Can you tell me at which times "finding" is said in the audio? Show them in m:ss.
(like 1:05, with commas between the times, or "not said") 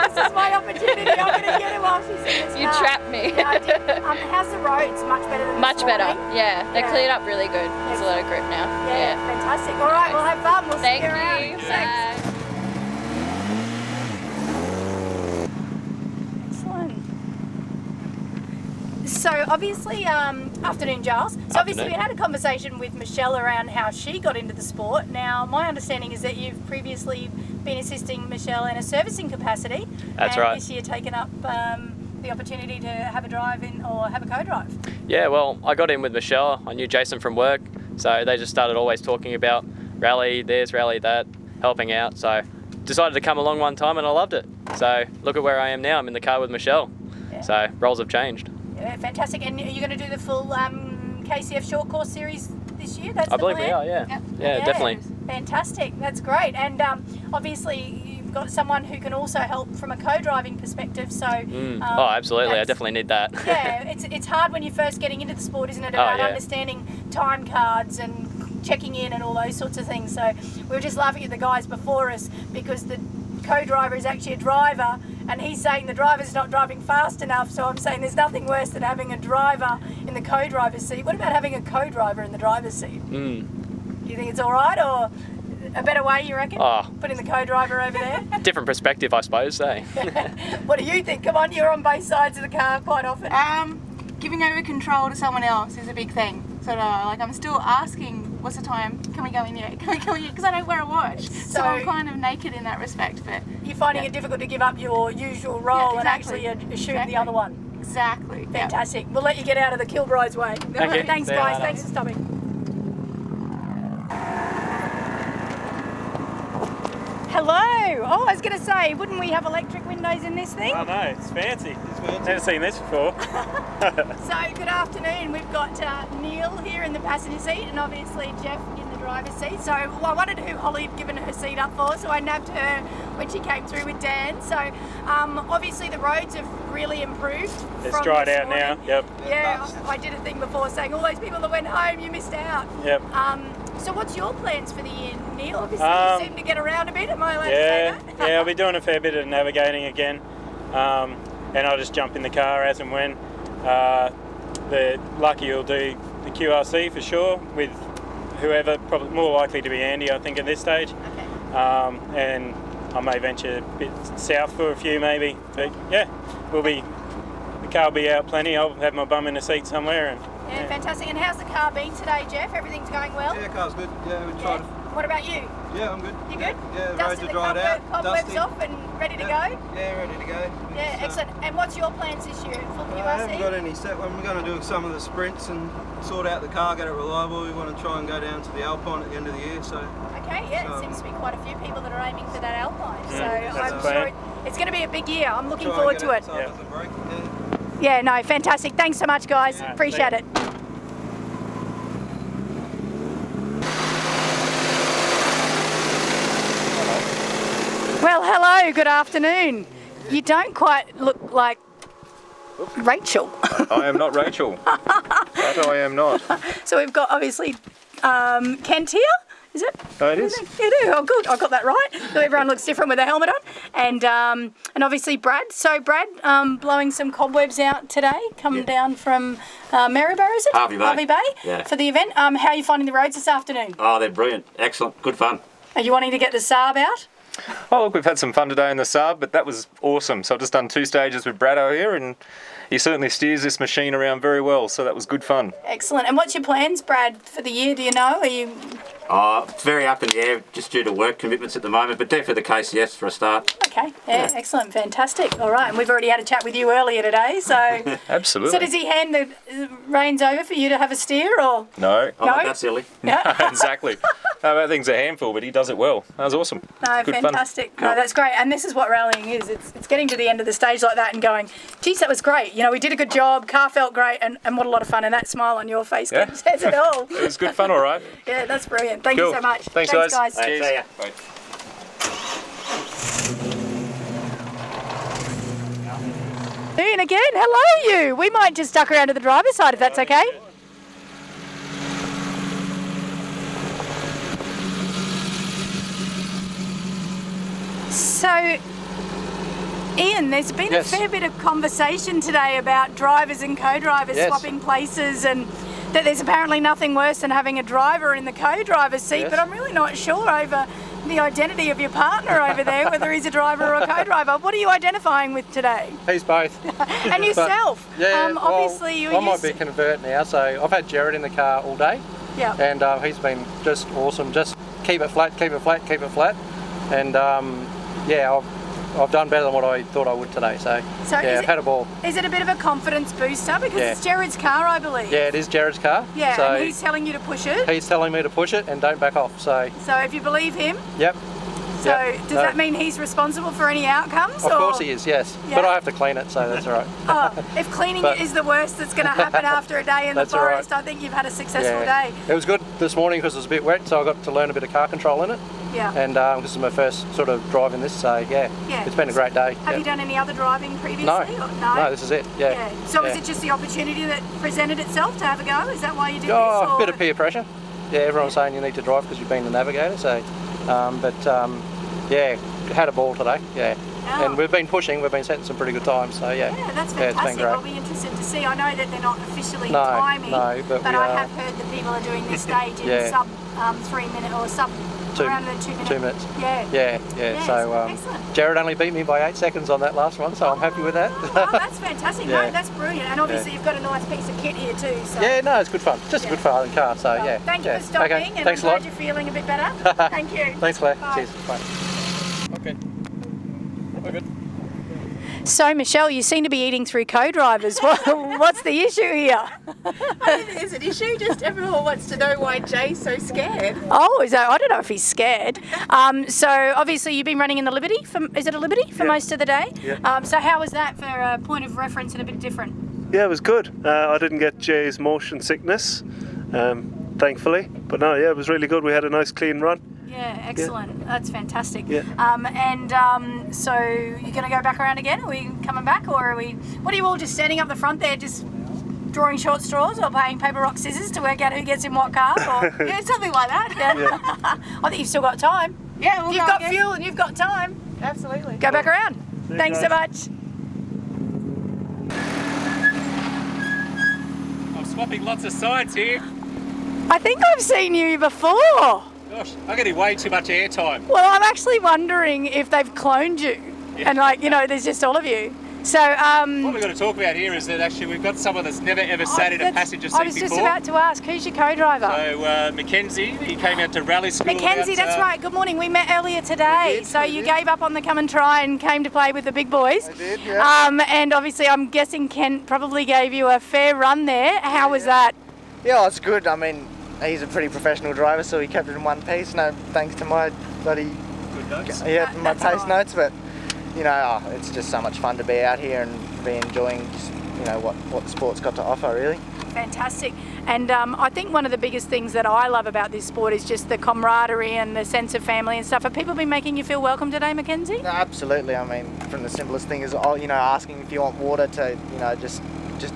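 1:43, 3:52.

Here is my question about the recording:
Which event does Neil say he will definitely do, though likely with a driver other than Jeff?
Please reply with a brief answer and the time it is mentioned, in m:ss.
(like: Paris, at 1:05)
QRC, at 2:36.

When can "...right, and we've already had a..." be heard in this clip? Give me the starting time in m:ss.
4:15.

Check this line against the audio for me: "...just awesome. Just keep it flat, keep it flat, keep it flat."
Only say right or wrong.
right.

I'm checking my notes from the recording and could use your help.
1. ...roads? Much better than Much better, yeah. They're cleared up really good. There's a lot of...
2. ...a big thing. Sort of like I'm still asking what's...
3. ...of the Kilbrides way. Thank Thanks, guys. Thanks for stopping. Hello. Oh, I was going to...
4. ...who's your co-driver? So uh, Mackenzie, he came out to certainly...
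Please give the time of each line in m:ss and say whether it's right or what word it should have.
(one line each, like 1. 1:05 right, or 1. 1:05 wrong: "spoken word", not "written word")
1. 0:04 right
2. 1:35 right
3. 1:49 right
4. 7:51 wrong: "rally", not "certainly".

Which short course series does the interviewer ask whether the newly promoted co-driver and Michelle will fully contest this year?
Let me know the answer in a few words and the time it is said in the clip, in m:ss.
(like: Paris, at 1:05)
KCF short course series, at 0:51.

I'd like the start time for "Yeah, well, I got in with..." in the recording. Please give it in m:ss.
0:35.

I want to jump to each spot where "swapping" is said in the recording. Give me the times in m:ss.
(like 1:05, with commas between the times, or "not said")
5:04, 7:34.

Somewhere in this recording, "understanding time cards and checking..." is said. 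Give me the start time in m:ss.
1:06.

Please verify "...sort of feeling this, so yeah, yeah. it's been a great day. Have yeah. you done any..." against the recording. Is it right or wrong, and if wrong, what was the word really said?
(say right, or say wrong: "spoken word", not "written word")
wrong: "driving", not "feeling".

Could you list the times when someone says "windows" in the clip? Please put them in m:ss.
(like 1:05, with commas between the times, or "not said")
1:59.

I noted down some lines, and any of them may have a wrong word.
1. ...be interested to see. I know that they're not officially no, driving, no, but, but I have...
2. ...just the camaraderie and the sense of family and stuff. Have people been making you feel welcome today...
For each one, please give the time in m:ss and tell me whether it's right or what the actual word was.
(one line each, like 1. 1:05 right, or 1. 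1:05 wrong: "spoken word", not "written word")
1. 6:17 wrong: "timing", not "driving"
2. 8:23 right.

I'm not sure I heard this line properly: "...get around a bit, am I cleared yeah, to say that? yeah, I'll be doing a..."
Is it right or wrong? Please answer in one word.
wrong.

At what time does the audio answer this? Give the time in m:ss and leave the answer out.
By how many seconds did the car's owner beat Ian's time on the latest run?
6:29.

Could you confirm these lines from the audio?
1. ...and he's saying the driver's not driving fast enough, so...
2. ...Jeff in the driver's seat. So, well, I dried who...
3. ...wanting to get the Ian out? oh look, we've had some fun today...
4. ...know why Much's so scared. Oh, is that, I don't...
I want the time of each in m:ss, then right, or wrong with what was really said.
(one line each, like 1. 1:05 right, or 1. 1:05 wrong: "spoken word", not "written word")
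1. 1:15 right
2. 2:08 wrong: "wanted", not "dried"
3. 3:55 wrong: "Saab", not "Ian"
4. 6:52 wrong: "Jay", not "Much".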